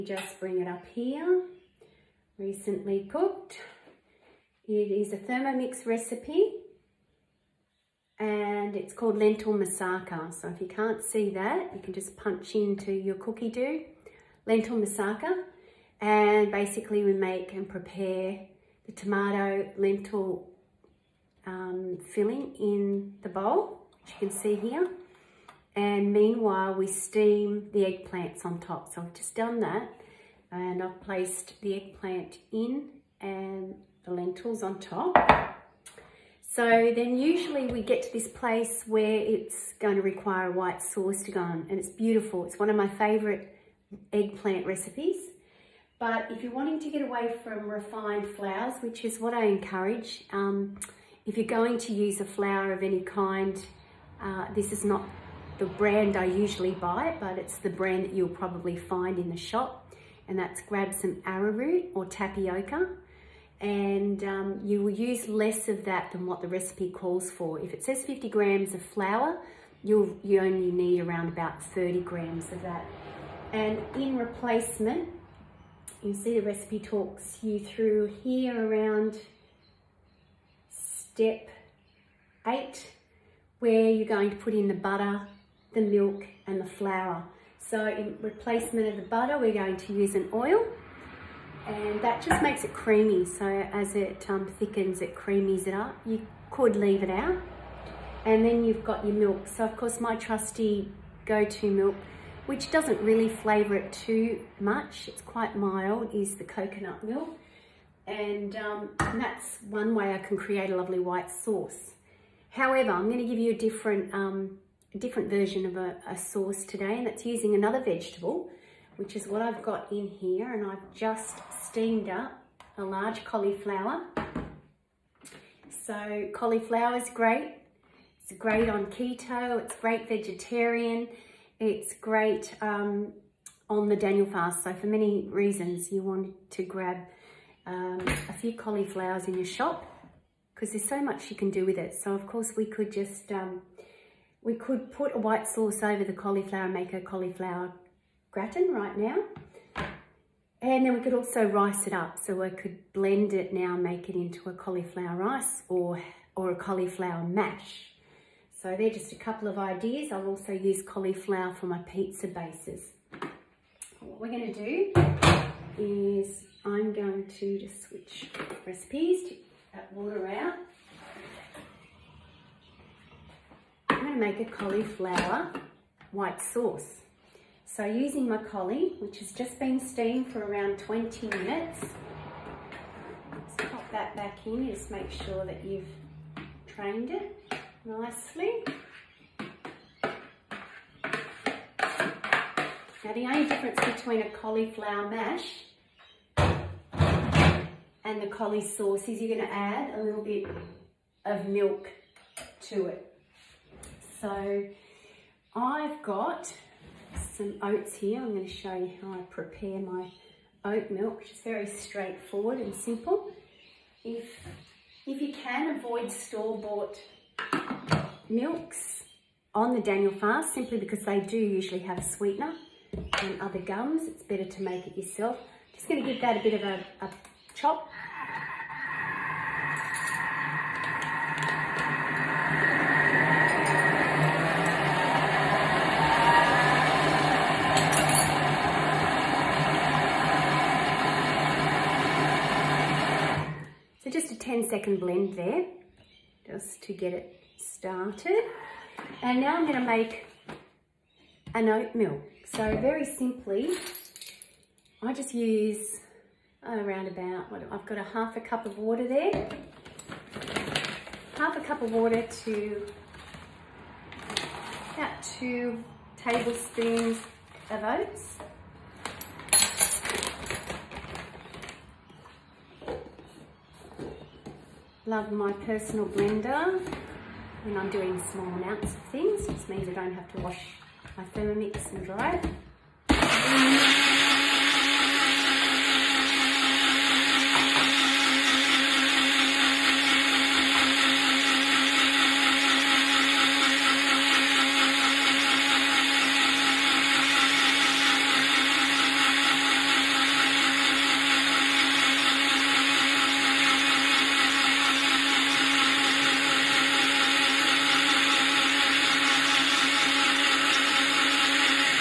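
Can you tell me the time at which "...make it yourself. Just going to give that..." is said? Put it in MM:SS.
03:44.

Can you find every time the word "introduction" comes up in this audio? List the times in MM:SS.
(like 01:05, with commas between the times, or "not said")
not said.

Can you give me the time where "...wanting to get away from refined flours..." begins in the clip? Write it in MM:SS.
00:46.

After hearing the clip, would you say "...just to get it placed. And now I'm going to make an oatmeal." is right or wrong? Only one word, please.
wrong.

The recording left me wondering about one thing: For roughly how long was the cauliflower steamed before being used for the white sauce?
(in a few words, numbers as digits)
20 minutes.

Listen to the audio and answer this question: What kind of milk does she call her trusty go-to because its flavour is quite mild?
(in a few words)
Coconut milk.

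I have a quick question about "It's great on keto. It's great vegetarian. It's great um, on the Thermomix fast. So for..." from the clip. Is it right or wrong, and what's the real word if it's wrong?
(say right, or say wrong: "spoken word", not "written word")
wrong: "Daniel", not "Thermomix".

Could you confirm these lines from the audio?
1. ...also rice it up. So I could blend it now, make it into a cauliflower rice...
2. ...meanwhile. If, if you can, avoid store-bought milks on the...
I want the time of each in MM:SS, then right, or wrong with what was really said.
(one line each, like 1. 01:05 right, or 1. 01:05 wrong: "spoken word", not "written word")
1. 02:31 right
2. 03:32 wrong: "simple", not "meanwhile".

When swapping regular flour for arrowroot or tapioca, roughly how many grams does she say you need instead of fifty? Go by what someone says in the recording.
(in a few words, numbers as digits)
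30 grams.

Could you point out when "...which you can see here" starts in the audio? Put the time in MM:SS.
00:24.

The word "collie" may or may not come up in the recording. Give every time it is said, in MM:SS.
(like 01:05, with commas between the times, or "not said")
02:58, 03:18.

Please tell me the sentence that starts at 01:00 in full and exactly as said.
And that's grab some arrowroot or tapioca and um, you will use less of that than what the recipe calls for.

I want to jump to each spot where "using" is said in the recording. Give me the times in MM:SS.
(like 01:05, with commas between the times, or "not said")
01:57, 02:57.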